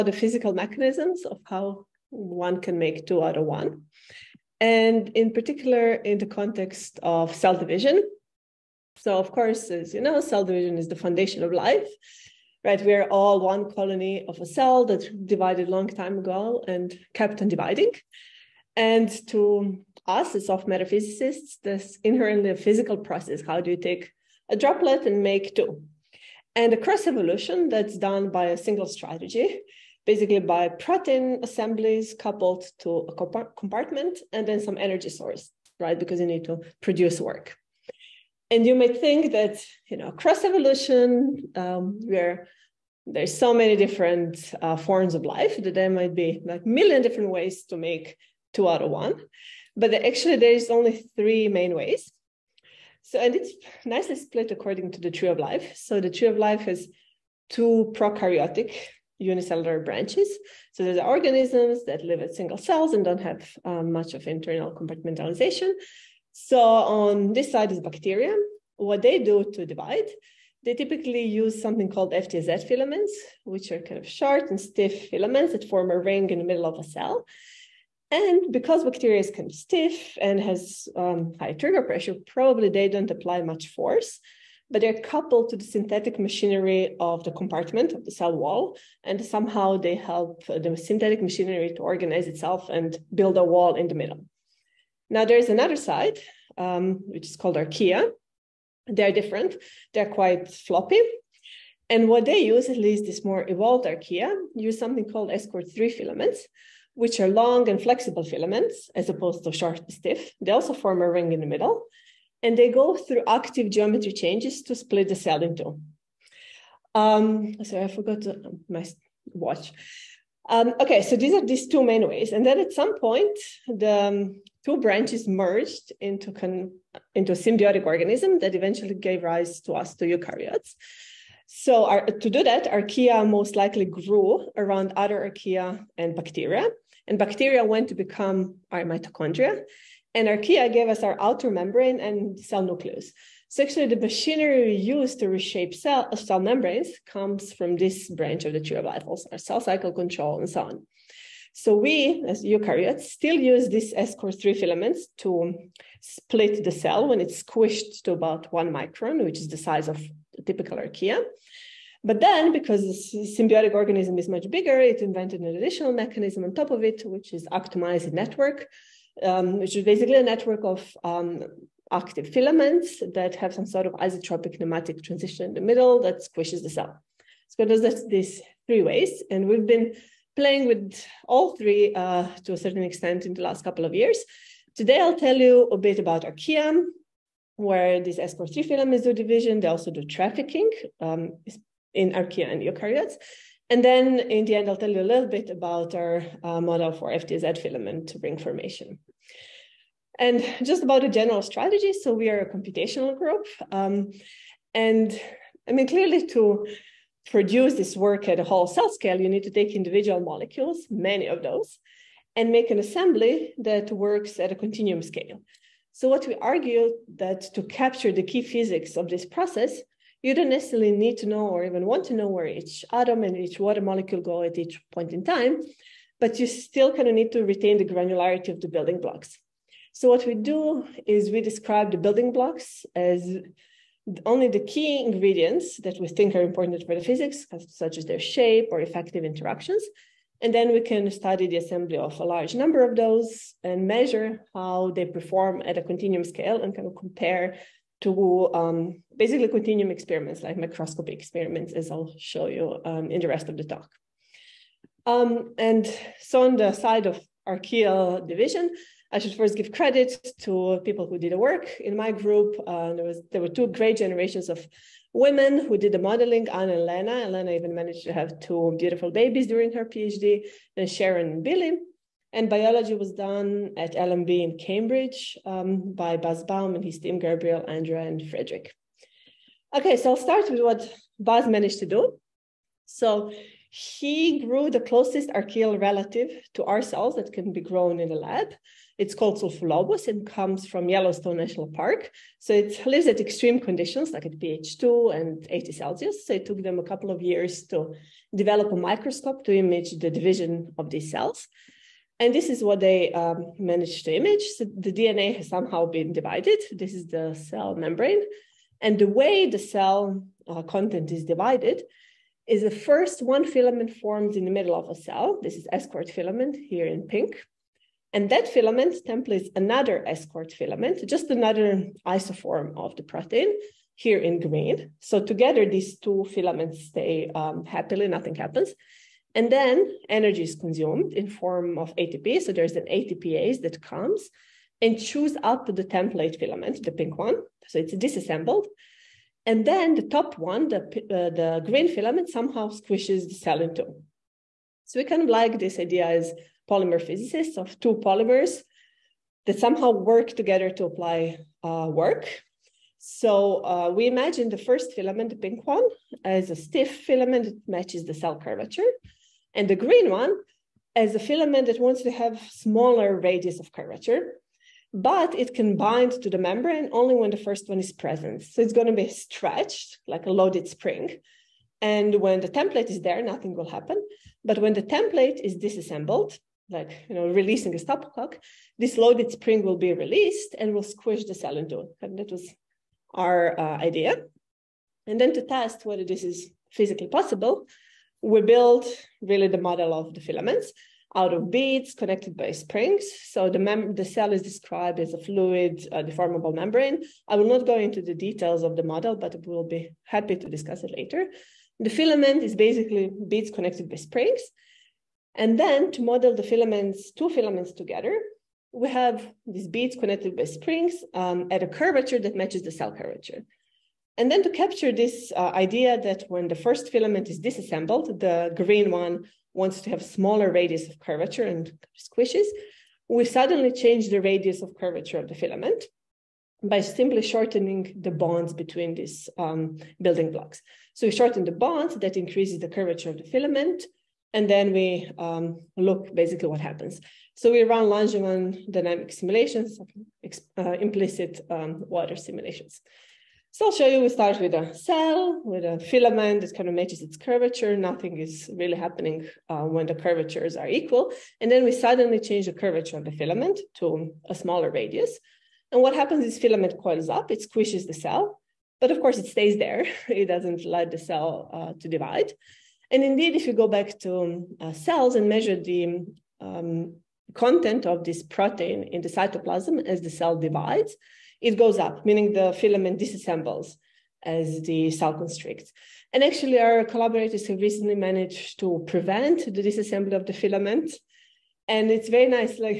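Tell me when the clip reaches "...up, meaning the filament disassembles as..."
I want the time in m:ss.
7:51.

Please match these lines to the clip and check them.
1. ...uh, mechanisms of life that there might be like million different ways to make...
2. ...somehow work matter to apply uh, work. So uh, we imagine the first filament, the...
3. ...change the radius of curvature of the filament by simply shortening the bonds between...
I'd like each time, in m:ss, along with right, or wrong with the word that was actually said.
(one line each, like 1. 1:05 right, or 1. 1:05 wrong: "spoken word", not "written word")
1. 0:44 wrong: "forms", not "mechanisms"
2. 5:49 wrong: "together", not "matter"
3. 7:03 right.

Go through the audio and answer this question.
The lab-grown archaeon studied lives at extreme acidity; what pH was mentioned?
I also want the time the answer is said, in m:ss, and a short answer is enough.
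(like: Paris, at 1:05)
pH 2, at 4:54.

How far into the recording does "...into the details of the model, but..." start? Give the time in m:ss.
6:37.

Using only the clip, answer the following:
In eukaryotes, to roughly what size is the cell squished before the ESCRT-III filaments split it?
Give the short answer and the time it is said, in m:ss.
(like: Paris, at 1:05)
1 micron, at 2:38.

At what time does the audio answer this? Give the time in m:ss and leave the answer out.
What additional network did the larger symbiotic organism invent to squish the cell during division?
2:47.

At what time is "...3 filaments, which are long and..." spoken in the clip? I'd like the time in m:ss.
1:45.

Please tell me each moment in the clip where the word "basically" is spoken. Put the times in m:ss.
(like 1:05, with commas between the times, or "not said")
0:30, 2:49, 4:09, 6:42, 7:16.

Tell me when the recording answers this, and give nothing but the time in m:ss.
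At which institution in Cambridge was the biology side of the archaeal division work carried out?
4:33.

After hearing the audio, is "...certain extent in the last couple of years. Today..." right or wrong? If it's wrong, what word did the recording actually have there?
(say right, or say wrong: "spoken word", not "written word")
right.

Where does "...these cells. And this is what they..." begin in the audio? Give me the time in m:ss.
5:00.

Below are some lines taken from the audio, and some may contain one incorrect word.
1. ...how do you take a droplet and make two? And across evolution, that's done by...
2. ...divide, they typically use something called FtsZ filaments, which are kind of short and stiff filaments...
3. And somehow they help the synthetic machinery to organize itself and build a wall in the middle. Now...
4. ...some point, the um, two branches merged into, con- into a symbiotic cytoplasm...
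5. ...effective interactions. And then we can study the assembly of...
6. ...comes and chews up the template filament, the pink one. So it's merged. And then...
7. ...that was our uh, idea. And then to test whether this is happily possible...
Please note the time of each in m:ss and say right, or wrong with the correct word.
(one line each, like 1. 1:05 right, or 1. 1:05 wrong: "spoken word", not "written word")
1. 0:23 right
2. 1:09 right
3. 1:29 right
4. 2:02 wrong: "organism", not "cytoplasm"
5. 3:58 right
6. 5:33 wrong: "disassembled", not "merged"
7. 6:22 wrong: "physically", not "happily".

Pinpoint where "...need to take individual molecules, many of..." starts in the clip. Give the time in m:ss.
3:29.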